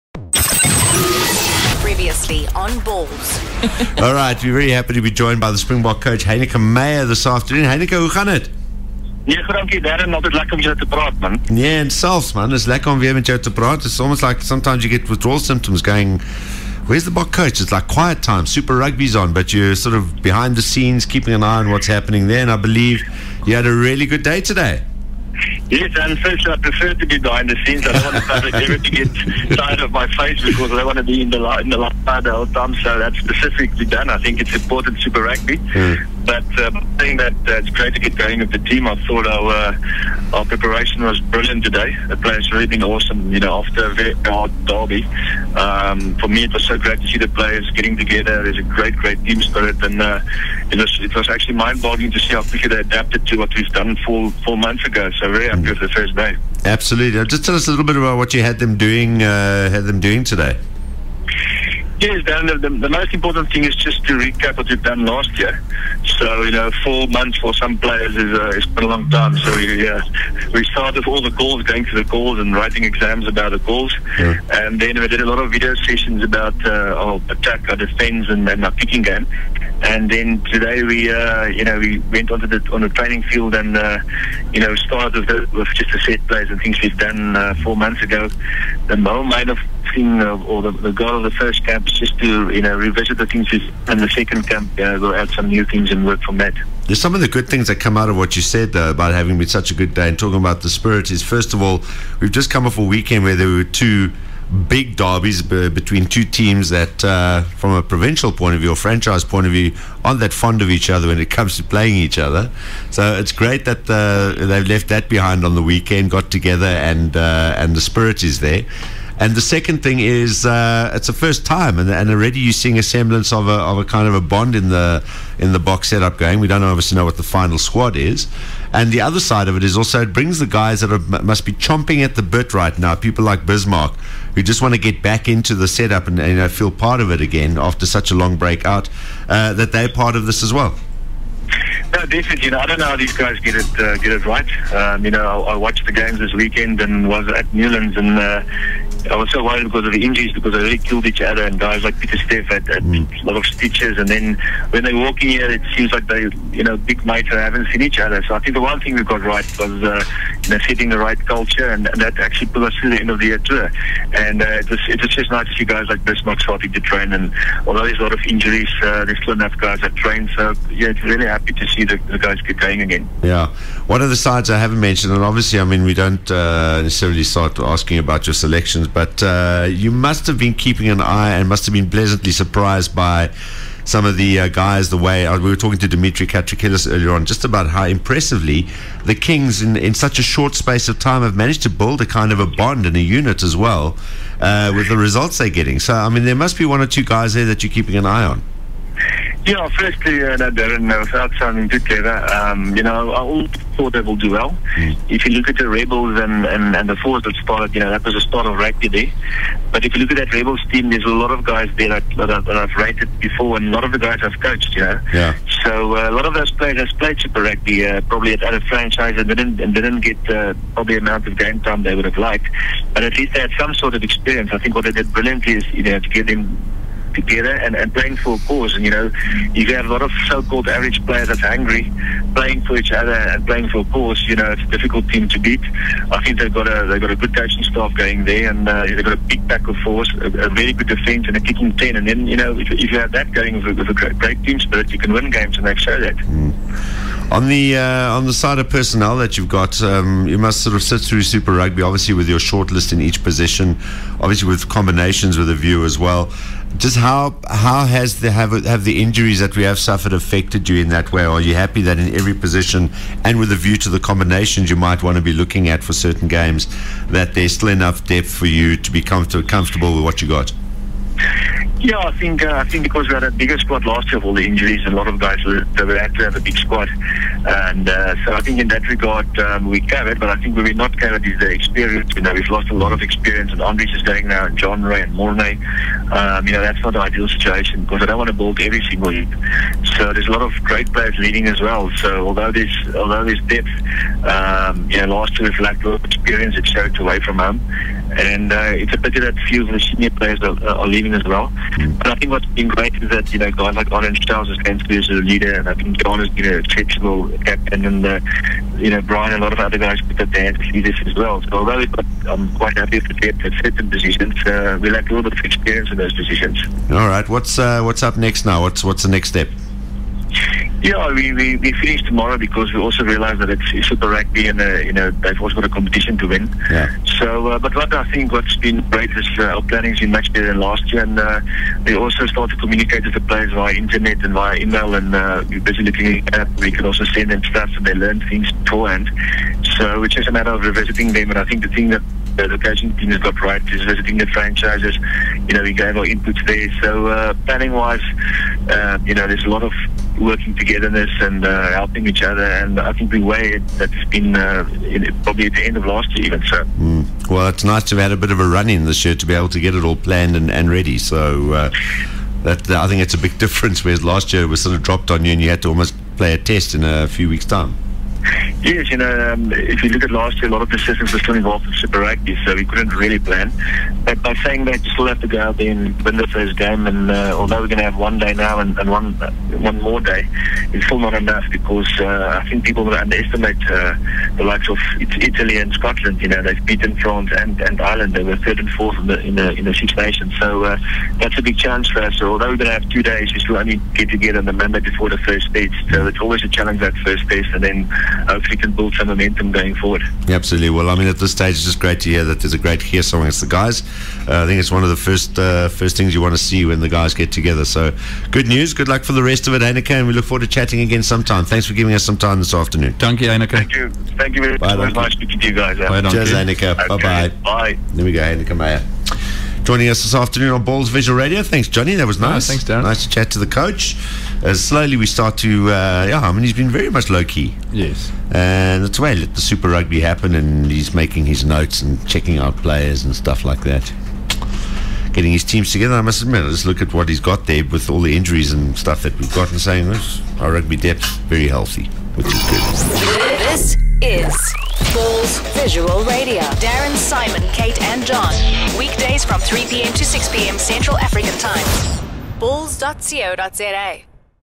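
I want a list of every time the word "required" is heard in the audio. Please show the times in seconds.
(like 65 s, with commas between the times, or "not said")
not said.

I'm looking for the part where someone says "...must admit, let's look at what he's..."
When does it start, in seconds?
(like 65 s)
436 s.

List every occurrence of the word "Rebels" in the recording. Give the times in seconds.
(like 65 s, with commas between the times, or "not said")
205 s, 210 s.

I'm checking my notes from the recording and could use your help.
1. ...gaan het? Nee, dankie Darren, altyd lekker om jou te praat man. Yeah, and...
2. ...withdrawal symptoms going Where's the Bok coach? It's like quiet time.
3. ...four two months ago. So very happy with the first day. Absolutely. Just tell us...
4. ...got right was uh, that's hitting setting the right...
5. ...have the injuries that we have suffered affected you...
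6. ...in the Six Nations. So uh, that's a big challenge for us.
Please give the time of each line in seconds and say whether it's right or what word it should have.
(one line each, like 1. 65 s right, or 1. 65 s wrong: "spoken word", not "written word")
1. 8 s right
2. 15 s right
3. 54 s wrong: "four", not "two"
4. 159 s right
5. 258 s right
6. 389 s right.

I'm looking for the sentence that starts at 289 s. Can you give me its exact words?
So there's a lot of great players leading as well.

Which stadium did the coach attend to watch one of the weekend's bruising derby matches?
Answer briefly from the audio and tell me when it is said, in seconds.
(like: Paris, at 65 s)
Newlands, at 147 s.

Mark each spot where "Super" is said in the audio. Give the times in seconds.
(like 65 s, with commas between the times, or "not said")
18 s, 34 s, 217 s, 251 s, 323 s, 371 s, 429 s.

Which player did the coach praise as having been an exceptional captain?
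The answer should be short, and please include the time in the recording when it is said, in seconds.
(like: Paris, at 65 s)
Jean, at 306 s.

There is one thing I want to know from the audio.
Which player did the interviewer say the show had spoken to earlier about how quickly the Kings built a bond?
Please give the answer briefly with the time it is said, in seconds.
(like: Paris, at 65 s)
Demetri Catrakilis, at 185 s.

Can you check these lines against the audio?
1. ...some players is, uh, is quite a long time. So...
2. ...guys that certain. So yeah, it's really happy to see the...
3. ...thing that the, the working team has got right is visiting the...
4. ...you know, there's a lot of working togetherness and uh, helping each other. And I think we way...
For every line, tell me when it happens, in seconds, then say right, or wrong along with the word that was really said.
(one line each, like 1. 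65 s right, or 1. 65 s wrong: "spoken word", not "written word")
1. 67 s right
2. 169 s wrong: "train", not "certain"
3. 341 s wrong: "coaching", not "working"
4. 349 s right.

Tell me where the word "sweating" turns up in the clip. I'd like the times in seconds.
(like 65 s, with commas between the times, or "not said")
not said.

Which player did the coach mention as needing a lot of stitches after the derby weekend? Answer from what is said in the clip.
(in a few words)
Pieter-Steph.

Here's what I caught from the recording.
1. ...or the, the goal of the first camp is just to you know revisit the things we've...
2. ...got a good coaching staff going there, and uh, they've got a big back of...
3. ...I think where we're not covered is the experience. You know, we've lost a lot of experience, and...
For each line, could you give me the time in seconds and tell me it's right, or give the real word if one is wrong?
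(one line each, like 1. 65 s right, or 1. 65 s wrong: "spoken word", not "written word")
1. 90 s right
2. 237 s right
3. 280 s right.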